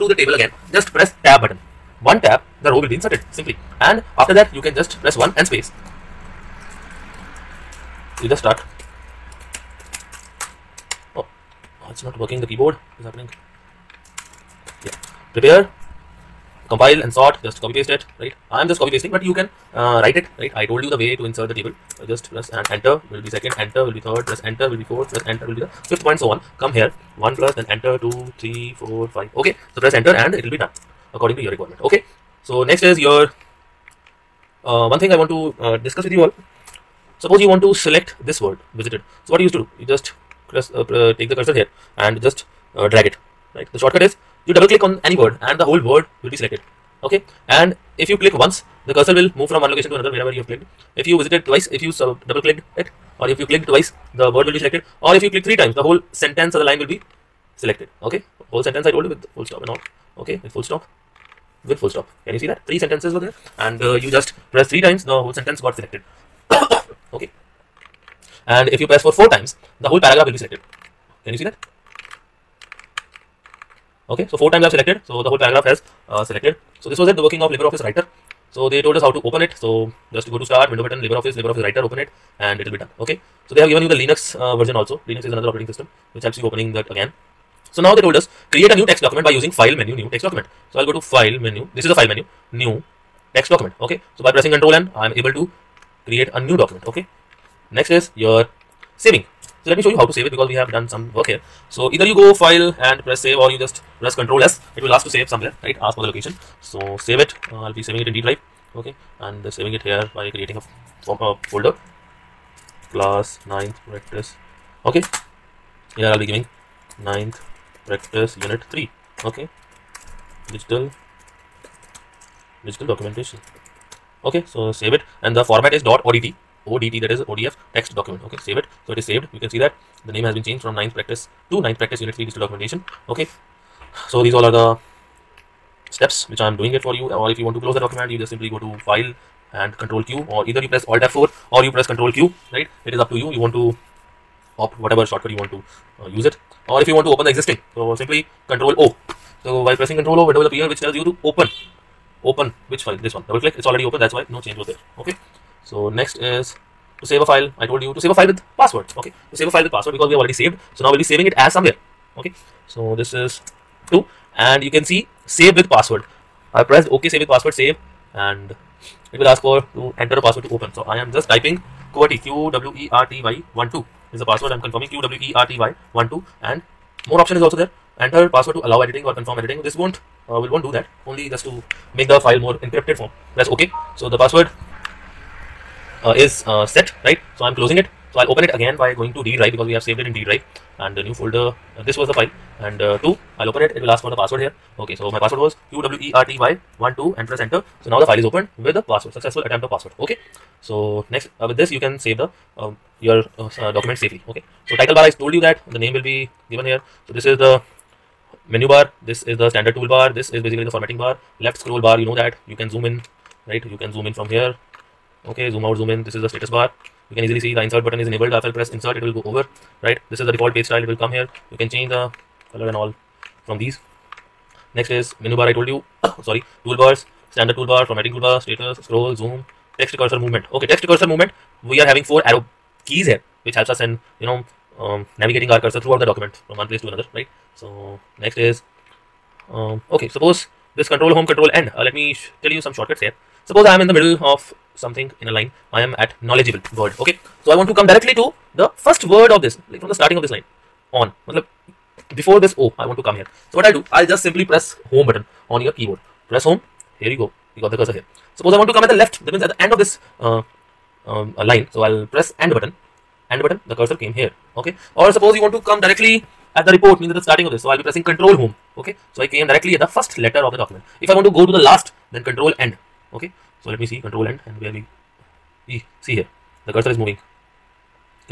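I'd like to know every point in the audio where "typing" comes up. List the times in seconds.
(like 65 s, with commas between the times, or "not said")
171 s.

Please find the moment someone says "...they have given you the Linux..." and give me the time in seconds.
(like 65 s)
83 s.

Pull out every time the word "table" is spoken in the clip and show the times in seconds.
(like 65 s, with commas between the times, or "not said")
0 s, 21 s.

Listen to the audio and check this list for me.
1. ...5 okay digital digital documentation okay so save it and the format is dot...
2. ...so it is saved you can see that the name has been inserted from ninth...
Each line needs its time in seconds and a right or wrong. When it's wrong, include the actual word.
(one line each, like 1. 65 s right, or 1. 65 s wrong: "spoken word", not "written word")
1. 118 s wrong: "3", not "5"
2. 128 s wrong: "changed", not "inserted".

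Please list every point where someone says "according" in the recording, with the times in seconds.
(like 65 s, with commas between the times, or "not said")
31 s.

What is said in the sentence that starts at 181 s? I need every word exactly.
Only just to make the file more encrypted form.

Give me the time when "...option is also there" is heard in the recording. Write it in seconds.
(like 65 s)
177 s.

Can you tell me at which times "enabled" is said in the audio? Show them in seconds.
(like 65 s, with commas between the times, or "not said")
218 s.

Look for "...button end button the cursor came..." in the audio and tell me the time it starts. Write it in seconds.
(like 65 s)
262 s.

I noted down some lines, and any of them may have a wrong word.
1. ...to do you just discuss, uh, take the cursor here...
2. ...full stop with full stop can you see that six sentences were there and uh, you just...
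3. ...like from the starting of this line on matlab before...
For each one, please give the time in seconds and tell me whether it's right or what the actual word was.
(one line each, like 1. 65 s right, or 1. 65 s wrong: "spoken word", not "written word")
1. 39 s wrong: "press", not "discuss"
2. 60 s wrong: "three", not "six"
3. 249 s right.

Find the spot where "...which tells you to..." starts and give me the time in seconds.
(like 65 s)
150 s.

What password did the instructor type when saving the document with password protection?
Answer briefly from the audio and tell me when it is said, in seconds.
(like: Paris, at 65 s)
QWERTY12, at 195 s.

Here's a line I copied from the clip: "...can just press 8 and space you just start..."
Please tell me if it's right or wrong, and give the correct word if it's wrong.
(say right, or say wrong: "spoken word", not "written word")
wrong: "1", not "8".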